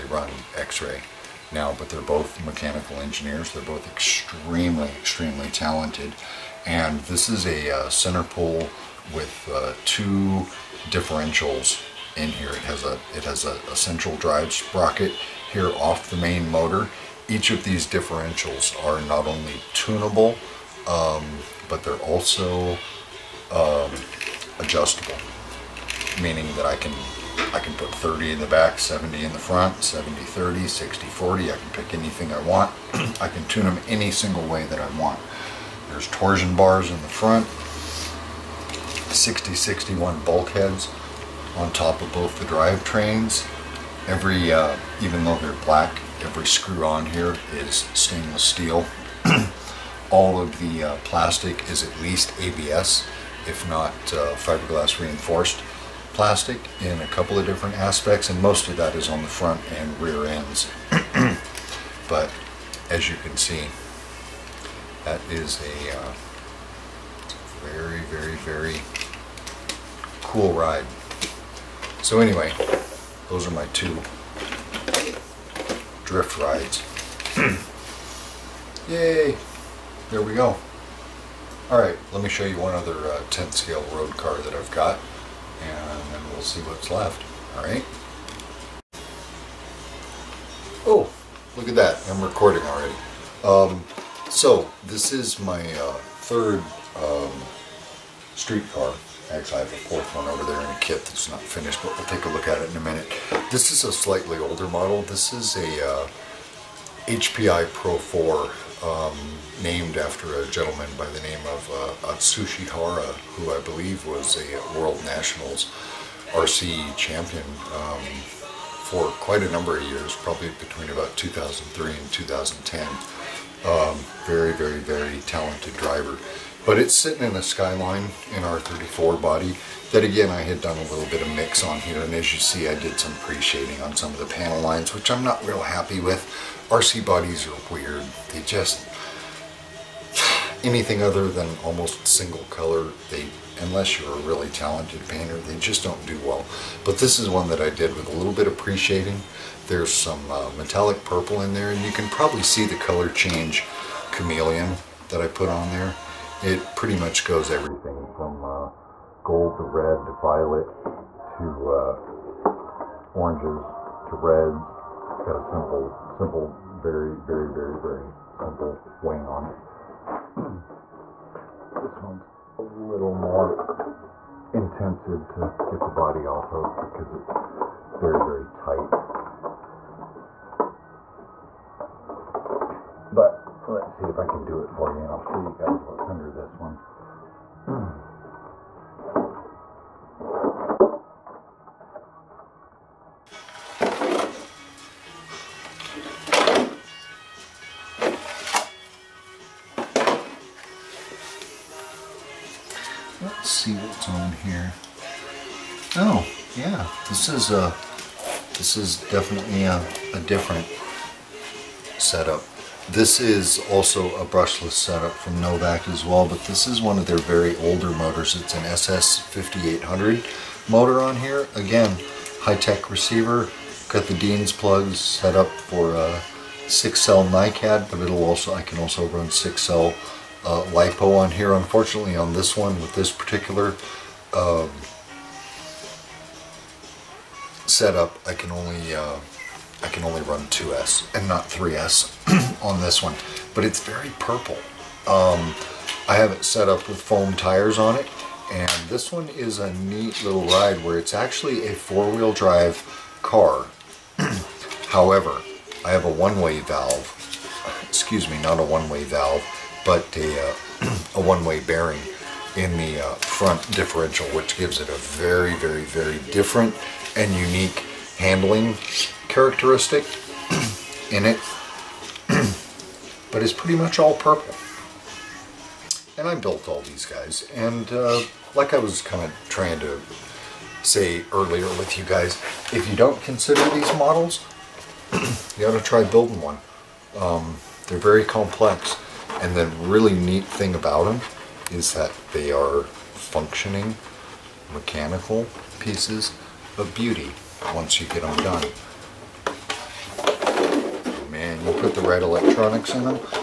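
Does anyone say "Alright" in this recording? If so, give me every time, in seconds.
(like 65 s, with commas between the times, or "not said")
81 s, 87 s.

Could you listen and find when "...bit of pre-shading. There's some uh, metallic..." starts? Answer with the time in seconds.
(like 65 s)
148 s.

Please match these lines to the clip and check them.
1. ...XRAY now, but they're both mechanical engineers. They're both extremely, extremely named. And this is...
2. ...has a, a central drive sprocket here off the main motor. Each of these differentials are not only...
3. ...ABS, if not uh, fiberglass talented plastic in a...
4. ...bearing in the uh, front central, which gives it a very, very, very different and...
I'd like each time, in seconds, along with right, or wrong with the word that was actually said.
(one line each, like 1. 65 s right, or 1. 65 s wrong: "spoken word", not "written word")
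1. 0 s wrong: "talented", not "named"
2. 13 s right
3. 52 s wrong: "reinforced", not "talented"
4. 261 s wrong: "differential", not "central".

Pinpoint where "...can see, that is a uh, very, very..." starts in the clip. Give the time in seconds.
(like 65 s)
63 s.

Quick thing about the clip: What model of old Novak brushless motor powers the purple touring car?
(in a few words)
SS5800.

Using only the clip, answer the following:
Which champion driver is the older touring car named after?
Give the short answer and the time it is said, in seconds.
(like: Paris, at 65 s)
Atsushi Hara, at 112 s.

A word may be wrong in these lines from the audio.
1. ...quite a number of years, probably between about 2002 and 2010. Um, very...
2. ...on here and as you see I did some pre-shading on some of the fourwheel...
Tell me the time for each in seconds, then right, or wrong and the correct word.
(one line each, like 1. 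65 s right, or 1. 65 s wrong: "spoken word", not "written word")
1. 119 s wrong: "2003", not "2002"
2. 131 s wrong: "panel", not "fourwheel".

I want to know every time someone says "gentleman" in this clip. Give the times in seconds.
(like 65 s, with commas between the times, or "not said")
110 s.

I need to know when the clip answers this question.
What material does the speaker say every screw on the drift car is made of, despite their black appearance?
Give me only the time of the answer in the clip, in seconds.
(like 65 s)
47 s.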